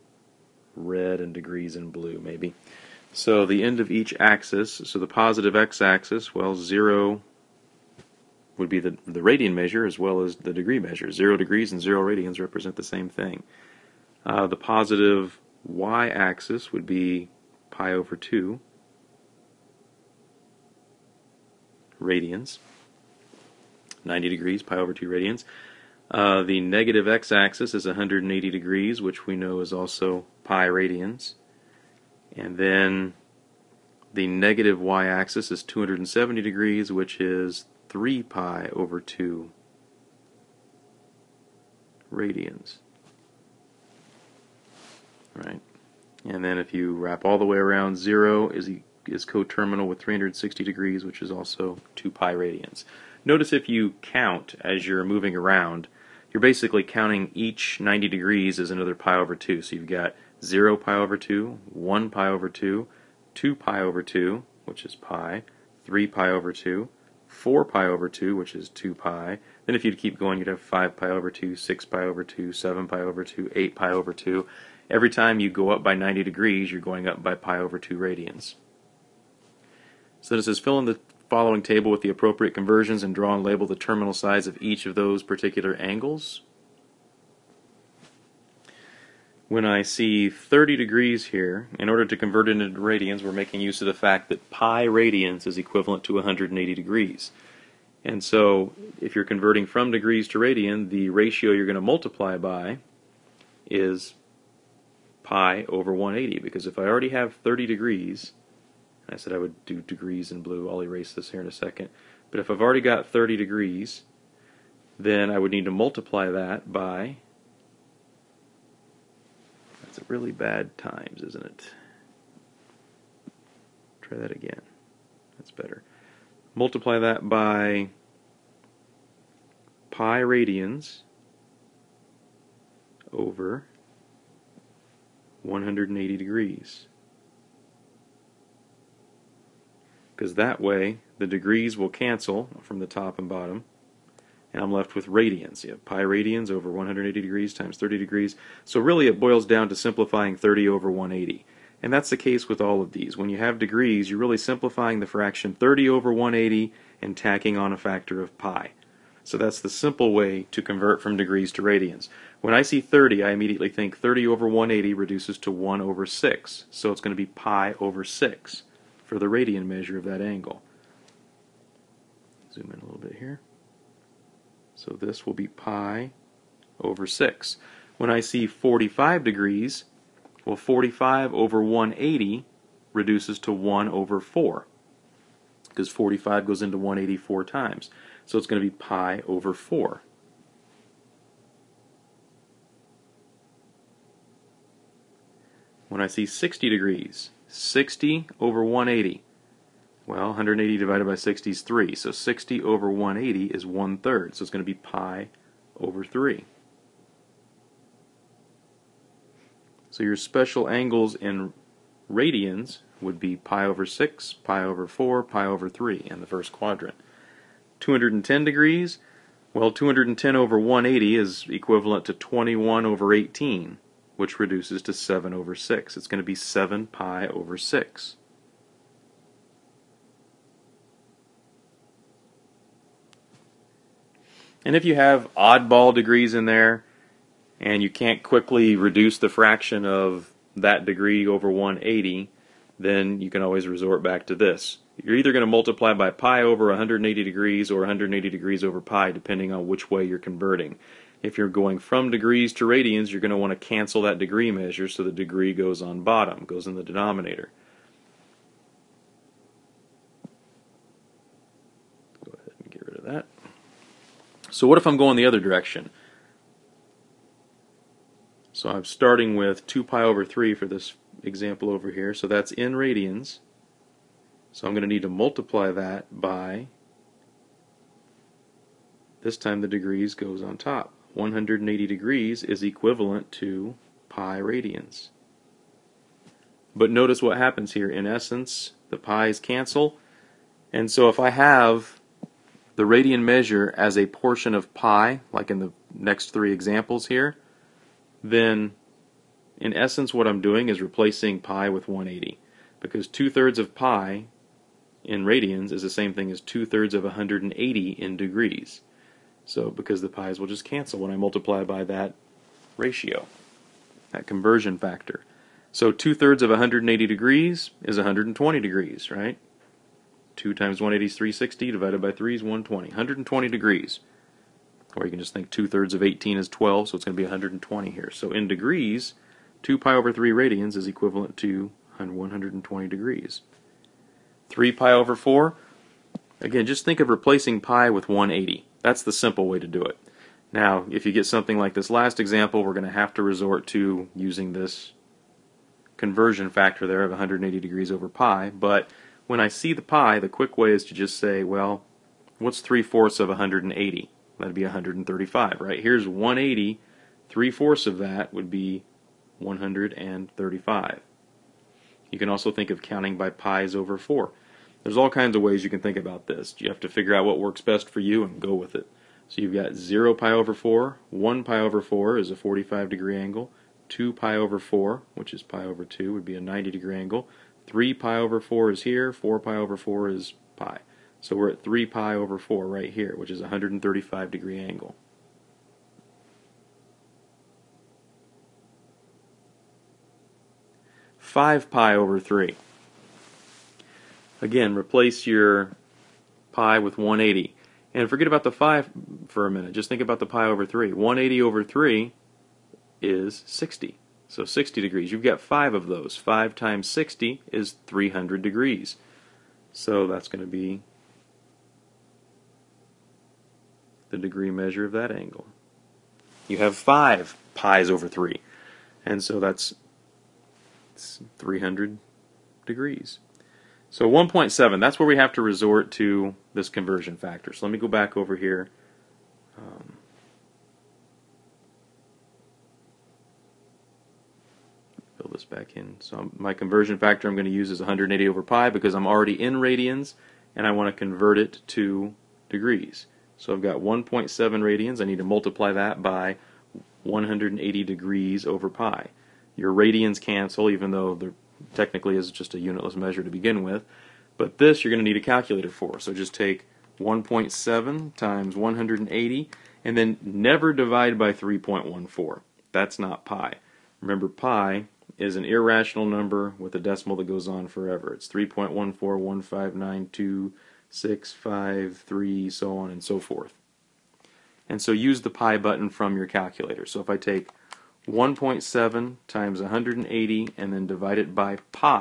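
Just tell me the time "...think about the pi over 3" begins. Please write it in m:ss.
6:39.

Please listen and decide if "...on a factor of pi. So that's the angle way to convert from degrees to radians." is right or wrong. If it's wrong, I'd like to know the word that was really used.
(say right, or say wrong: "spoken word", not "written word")
wrong: "simple", not "angle".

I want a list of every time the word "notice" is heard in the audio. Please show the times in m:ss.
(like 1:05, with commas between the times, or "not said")
0:53, 4:46.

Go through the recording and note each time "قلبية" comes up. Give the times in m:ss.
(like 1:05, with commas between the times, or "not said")
not said.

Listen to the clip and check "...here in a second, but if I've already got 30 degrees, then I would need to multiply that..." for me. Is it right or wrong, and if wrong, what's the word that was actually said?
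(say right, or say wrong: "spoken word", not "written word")
right.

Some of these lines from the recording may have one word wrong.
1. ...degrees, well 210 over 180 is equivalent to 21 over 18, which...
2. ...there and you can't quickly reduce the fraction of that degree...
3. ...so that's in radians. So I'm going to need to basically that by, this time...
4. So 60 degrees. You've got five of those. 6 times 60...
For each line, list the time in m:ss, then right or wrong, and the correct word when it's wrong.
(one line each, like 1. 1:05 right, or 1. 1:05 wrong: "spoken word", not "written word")
1. 3:38 right
2. 3:56 right
3. 4:32 wrong: "multiply", not "basically"
4. 6:44 wrong: "5", not "6".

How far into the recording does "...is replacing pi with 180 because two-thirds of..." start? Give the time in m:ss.
5:00.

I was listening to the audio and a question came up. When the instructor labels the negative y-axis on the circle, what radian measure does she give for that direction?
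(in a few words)
3 pi over 2.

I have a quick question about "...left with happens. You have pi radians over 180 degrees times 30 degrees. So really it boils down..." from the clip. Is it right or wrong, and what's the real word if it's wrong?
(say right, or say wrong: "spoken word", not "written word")
wrong: "radians", not "happens".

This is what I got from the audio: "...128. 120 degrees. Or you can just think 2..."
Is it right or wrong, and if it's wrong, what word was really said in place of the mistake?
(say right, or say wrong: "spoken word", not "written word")
wrong: "120", not "128".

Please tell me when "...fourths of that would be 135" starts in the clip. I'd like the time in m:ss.
5:57.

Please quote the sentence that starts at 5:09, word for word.
So because the pi's will just cancel when I multiply by that ratio, that conversion factor.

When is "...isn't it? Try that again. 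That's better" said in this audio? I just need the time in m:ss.
2:01.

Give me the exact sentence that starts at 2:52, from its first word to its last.
Zoom in a little bit here.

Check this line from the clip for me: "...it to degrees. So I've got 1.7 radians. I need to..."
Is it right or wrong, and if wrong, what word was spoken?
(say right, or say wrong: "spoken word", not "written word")
right.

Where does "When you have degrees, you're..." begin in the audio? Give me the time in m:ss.
2:33.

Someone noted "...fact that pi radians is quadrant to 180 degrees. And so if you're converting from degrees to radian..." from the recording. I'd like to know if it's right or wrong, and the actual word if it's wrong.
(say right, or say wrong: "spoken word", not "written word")
wrong: "equivalent", not "quadrant".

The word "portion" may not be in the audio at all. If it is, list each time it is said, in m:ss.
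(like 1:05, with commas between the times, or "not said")
4:54.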